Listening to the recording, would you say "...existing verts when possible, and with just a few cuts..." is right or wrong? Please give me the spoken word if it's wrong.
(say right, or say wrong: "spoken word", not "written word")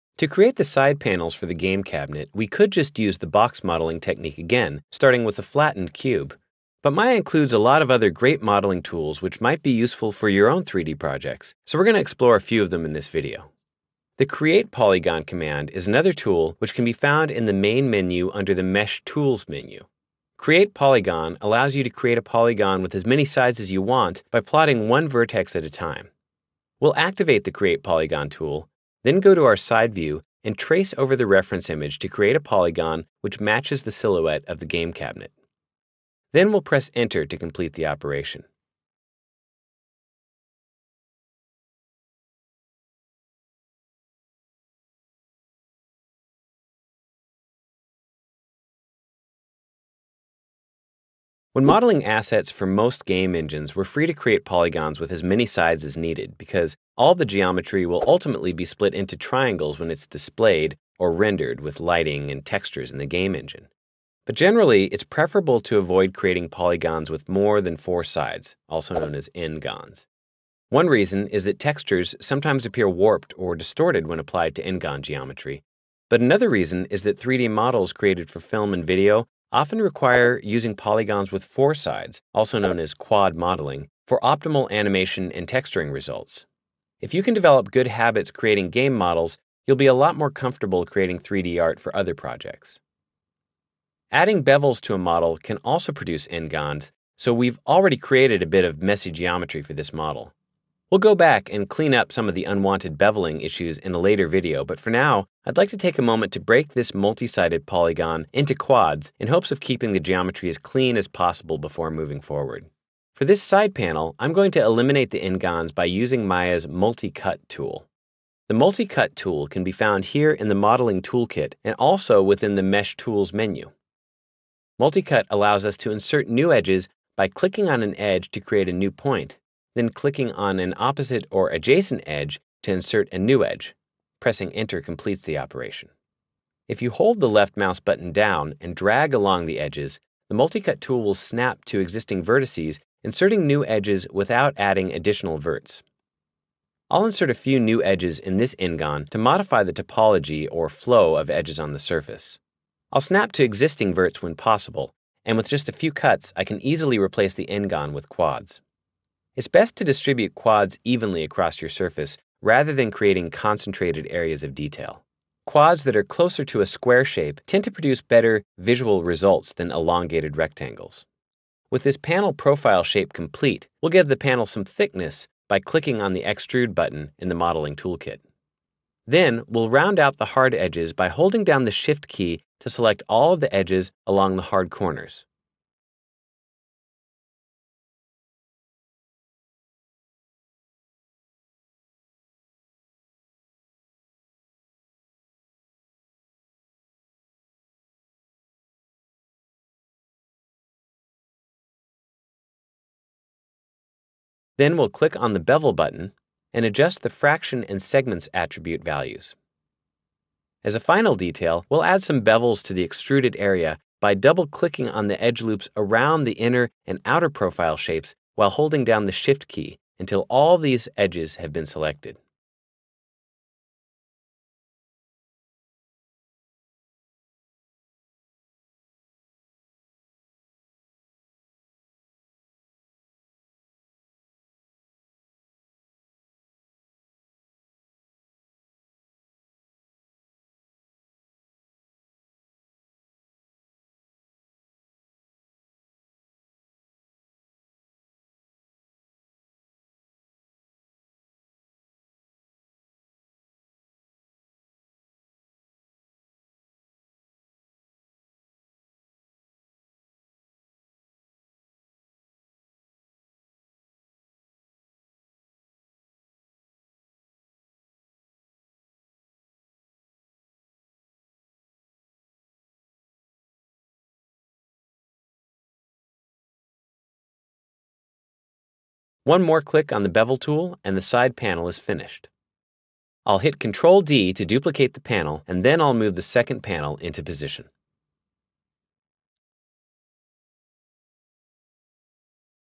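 right.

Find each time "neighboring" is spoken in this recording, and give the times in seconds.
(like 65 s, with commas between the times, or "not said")
not said.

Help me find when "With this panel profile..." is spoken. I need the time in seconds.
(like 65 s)
171 s.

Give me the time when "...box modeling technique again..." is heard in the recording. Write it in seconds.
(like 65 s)
3 s.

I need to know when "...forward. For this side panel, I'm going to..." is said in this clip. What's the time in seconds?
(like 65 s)
112 s.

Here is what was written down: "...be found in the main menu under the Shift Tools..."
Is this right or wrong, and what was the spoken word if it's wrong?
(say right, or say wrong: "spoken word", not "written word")
wrong: "Mesh", not "Shift".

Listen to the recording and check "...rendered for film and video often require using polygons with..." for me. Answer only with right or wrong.
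wrong.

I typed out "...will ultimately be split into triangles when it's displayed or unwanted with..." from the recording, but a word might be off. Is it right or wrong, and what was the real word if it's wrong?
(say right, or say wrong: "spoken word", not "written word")
wrong: "rendered", not "unwanted".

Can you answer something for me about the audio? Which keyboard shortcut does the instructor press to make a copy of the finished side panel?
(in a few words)
Ctrl D.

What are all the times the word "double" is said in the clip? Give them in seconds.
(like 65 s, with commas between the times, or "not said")
214 s.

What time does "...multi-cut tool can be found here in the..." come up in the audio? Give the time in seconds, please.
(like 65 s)
118 s.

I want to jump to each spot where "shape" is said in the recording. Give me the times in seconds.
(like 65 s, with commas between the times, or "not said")
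167 s, 172 s, 217 s.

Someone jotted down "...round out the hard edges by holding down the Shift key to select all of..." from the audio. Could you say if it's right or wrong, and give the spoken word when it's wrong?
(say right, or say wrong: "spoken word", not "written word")
right.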